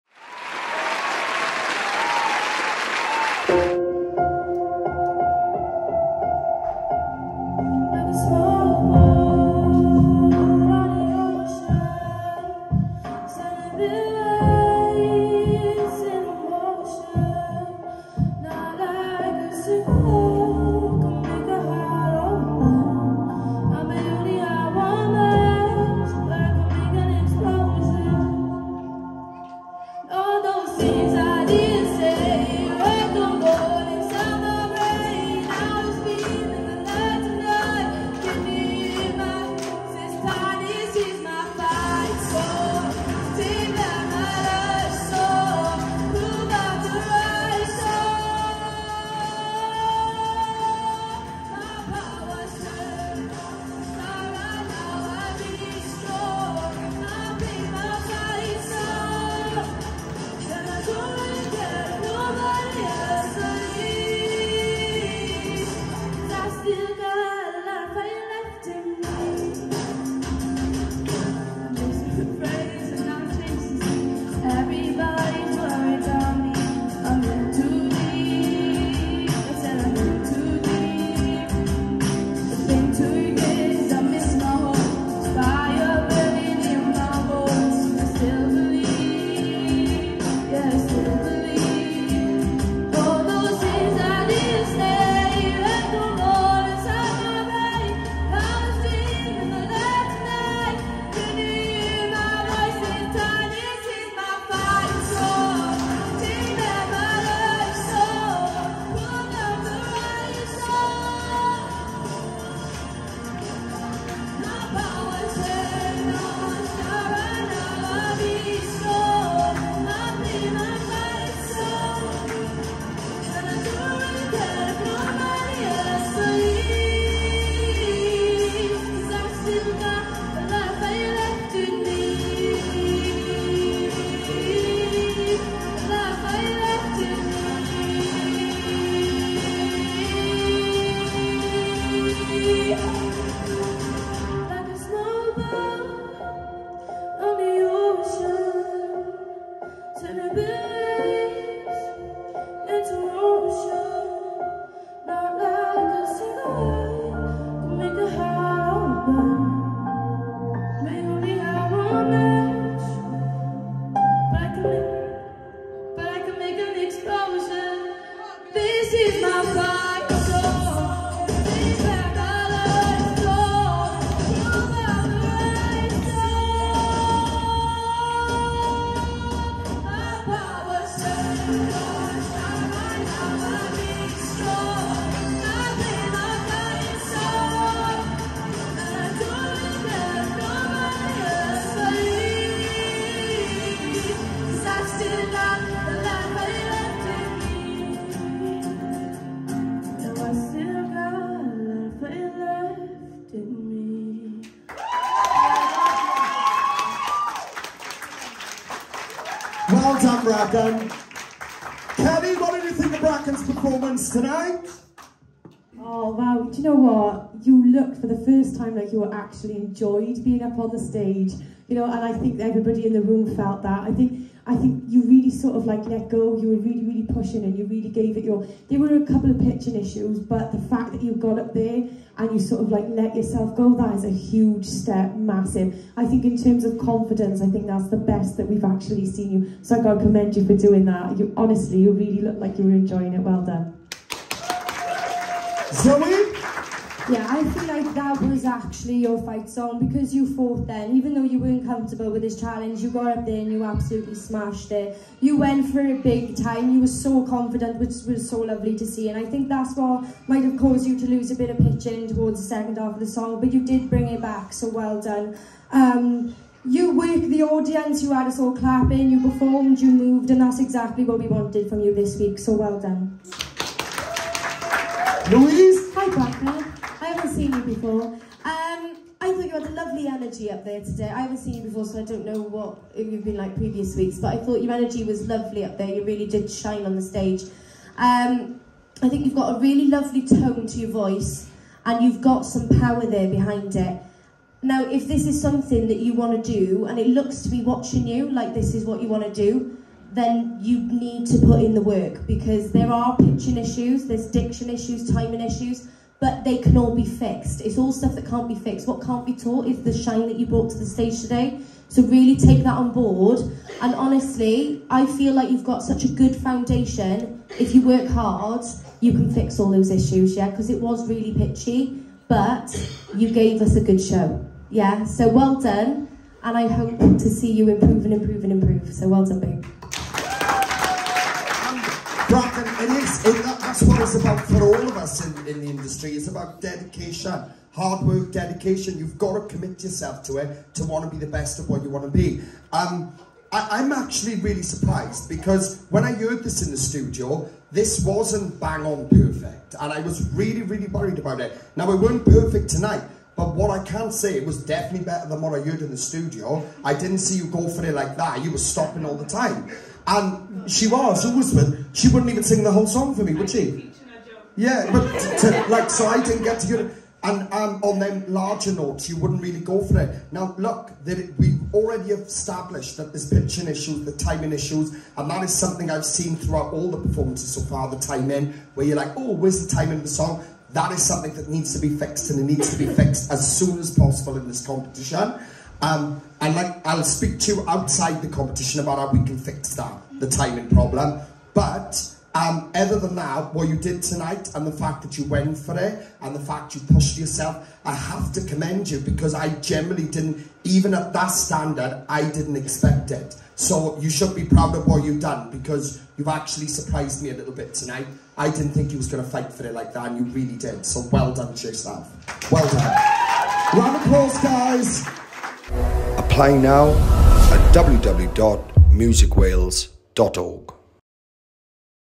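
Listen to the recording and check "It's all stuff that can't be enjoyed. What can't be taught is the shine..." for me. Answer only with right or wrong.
wrong.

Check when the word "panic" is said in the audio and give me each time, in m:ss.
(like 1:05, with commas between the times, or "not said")
not said.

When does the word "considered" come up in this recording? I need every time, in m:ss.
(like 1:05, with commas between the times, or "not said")
not said.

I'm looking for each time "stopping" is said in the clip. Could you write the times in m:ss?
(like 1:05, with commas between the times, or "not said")
5:58.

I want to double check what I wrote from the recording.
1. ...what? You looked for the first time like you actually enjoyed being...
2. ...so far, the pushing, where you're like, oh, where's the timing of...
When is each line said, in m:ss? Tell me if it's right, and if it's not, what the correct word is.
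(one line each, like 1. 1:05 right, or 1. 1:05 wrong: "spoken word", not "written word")
1. 3:36 right
2. 6:17 wrong: "timing", not "pushing".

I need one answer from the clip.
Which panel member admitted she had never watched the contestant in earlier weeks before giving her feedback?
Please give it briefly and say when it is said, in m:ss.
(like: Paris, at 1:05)
Louise, at 4:35.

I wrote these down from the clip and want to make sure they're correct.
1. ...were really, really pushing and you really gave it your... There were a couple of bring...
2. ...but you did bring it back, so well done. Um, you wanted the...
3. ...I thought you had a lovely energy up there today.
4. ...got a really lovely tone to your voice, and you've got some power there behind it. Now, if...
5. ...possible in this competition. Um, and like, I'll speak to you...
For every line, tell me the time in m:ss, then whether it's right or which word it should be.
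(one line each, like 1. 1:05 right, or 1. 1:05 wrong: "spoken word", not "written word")
1. 3:46 wrong: "pitching", not "bring"
2. 4:23 wrong: "worked", not "wanted"
3. 4:39 right
4. 4:49 right
5. 6:23 right.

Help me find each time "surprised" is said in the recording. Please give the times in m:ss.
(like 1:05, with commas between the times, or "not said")
5:44, 6:46.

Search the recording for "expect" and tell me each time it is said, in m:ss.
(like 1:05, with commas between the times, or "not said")
6:42.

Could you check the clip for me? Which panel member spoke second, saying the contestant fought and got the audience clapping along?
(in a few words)
Zoe.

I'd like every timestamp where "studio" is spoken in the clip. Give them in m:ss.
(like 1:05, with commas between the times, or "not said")
5:46, 5:55.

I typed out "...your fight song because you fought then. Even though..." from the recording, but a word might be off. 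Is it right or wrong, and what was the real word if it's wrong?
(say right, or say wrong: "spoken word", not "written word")
right.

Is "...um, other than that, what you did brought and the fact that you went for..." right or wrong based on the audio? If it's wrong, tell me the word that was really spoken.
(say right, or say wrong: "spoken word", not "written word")
wrong: "tonight", not "brought".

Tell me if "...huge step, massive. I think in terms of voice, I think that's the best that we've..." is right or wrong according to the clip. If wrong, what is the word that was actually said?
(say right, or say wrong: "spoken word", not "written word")
wrong: "confidence", not "voice".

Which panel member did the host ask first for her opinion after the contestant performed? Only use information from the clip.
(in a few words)
Kelly.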